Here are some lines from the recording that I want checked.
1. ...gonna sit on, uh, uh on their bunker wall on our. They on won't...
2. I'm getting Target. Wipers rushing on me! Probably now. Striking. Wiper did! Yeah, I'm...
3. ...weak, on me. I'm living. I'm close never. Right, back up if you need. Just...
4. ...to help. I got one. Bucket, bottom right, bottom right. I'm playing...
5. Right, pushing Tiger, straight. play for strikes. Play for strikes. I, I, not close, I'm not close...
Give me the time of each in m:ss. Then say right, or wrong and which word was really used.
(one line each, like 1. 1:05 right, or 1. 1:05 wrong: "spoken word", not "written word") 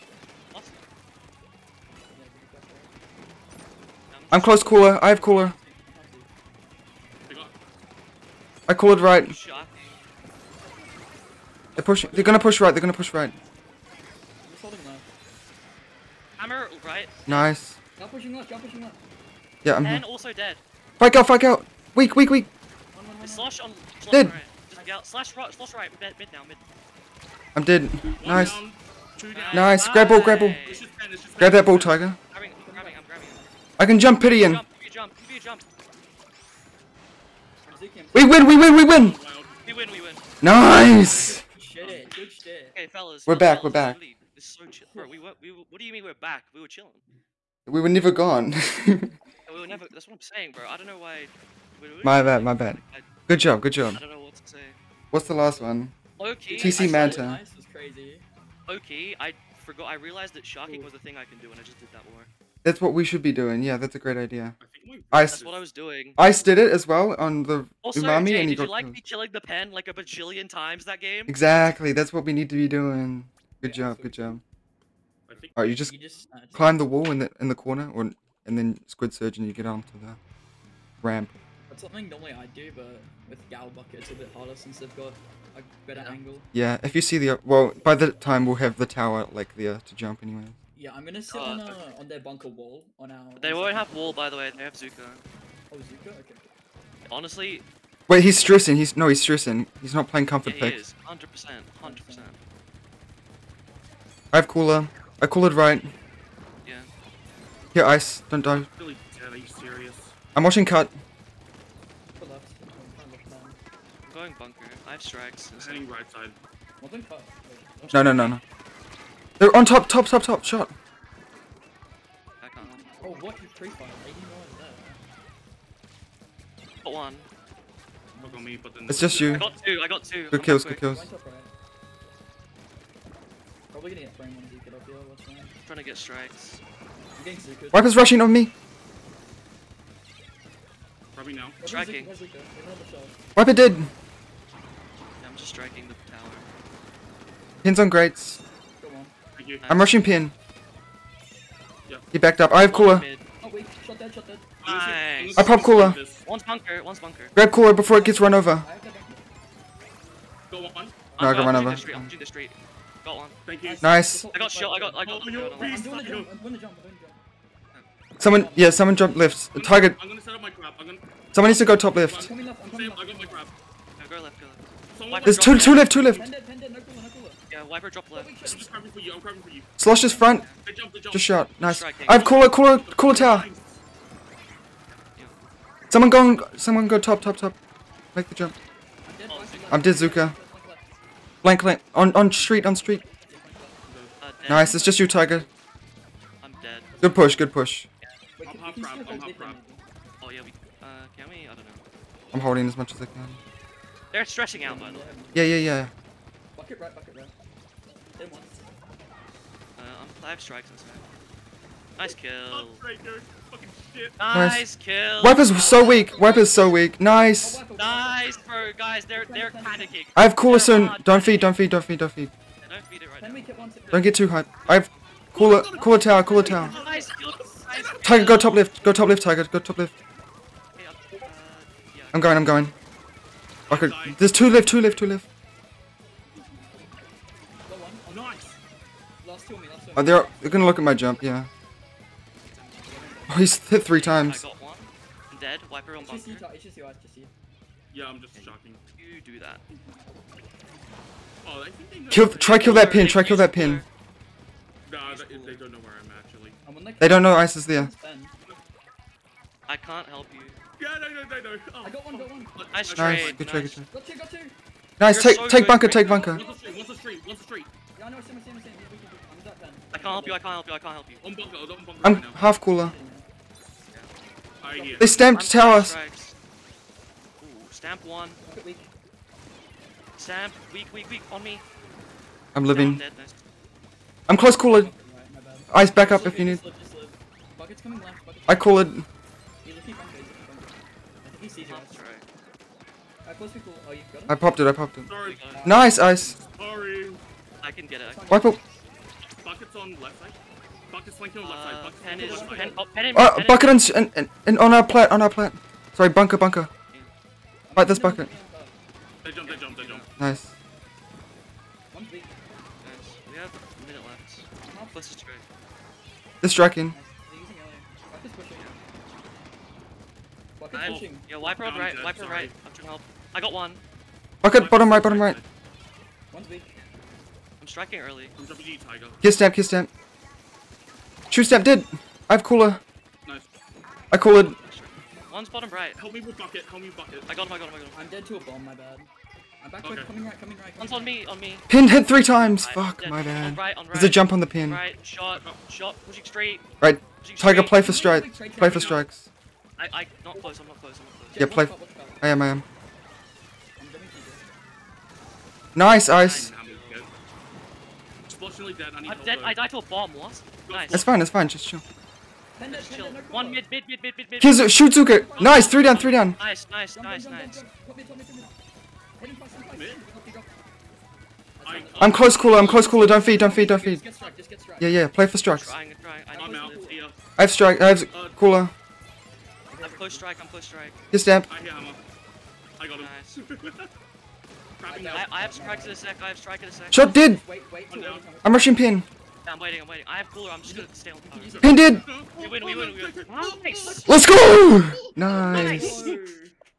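1. 1:31 right
2. 2:17 wrong: "Zuko", not "Target"
3. 4:41 wrong: "cooler", not "never"
4. 5:22 wrong: "striking", not "playing"
5. 5:46 right.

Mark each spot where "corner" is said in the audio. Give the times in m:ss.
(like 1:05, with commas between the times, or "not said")
1:17.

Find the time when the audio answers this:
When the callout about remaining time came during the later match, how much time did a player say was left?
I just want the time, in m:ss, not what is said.
5:13.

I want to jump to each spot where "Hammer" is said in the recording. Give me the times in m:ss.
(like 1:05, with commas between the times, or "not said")
0:16.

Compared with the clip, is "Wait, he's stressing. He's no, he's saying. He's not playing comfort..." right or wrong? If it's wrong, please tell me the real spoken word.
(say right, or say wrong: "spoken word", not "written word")
wrong: "stressing", not "saying".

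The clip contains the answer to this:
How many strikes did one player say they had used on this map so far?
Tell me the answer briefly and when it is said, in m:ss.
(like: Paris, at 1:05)
5, at 3:29.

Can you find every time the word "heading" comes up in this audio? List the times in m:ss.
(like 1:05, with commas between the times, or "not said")
1:55.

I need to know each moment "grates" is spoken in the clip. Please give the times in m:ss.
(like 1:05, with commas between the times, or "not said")
2:27.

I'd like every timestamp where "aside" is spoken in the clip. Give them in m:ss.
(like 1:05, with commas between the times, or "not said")
not said.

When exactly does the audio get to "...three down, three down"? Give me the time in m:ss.
6:05.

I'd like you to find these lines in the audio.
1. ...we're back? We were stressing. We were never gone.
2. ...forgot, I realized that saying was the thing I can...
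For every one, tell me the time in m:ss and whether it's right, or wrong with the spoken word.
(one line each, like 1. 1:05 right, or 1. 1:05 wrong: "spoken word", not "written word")
1. 0:46 wrong: "chilling", not "stressing"
2. 0:59 wrong: "shocking", not "saying".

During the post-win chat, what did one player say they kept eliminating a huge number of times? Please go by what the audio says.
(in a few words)
the pen.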